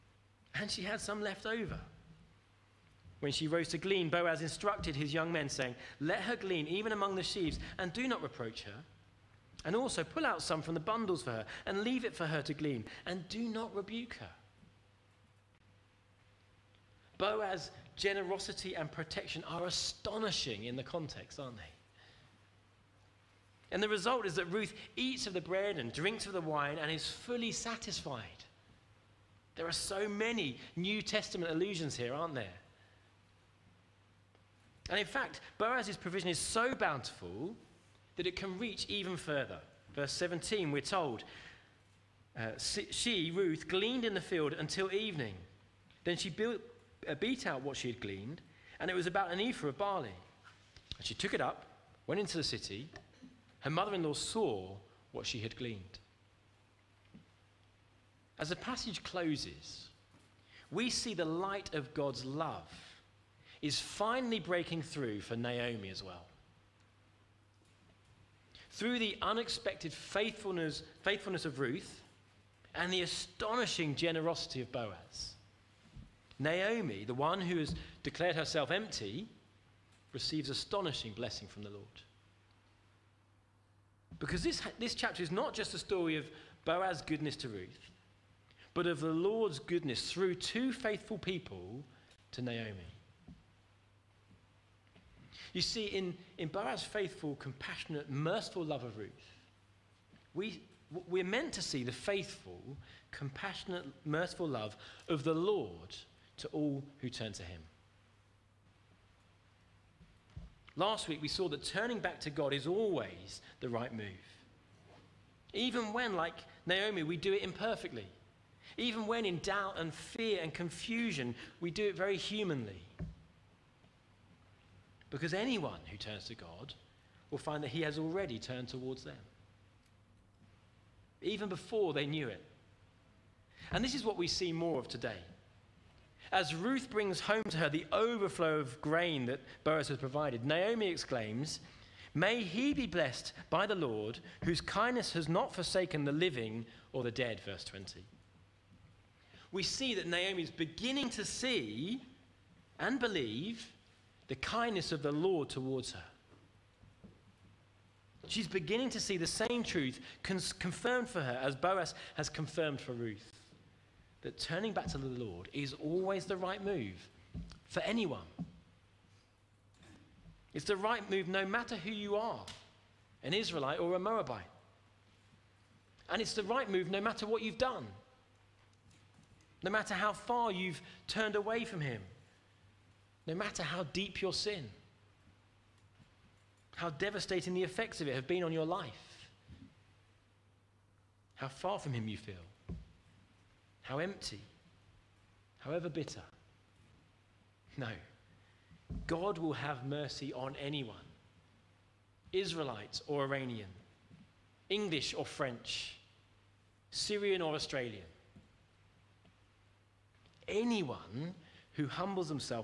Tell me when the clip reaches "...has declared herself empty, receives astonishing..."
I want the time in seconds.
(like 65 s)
77 s.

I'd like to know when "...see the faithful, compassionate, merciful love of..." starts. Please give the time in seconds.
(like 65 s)
101 s.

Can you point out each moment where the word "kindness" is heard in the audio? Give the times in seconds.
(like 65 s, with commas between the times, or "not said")
144 s, 154 s.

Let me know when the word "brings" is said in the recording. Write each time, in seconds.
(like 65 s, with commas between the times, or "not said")
136 s.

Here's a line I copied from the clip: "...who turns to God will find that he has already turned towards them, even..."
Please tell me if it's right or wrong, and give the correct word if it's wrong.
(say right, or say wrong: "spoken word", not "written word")
right.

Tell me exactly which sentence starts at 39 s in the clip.
Verse 17, we're told uh, she, Ruth, gleaned in the field until evening.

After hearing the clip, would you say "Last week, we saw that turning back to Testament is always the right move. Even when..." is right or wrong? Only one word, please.
wrong.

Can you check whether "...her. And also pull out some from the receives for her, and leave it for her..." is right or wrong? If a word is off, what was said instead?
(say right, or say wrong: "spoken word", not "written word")
wrong: "bundles", not "receives".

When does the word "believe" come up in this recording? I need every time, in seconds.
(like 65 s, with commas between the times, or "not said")
152 s.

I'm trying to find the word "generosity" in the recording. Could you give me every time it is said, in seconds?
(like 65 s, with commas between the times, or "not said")
17 s, 73 s.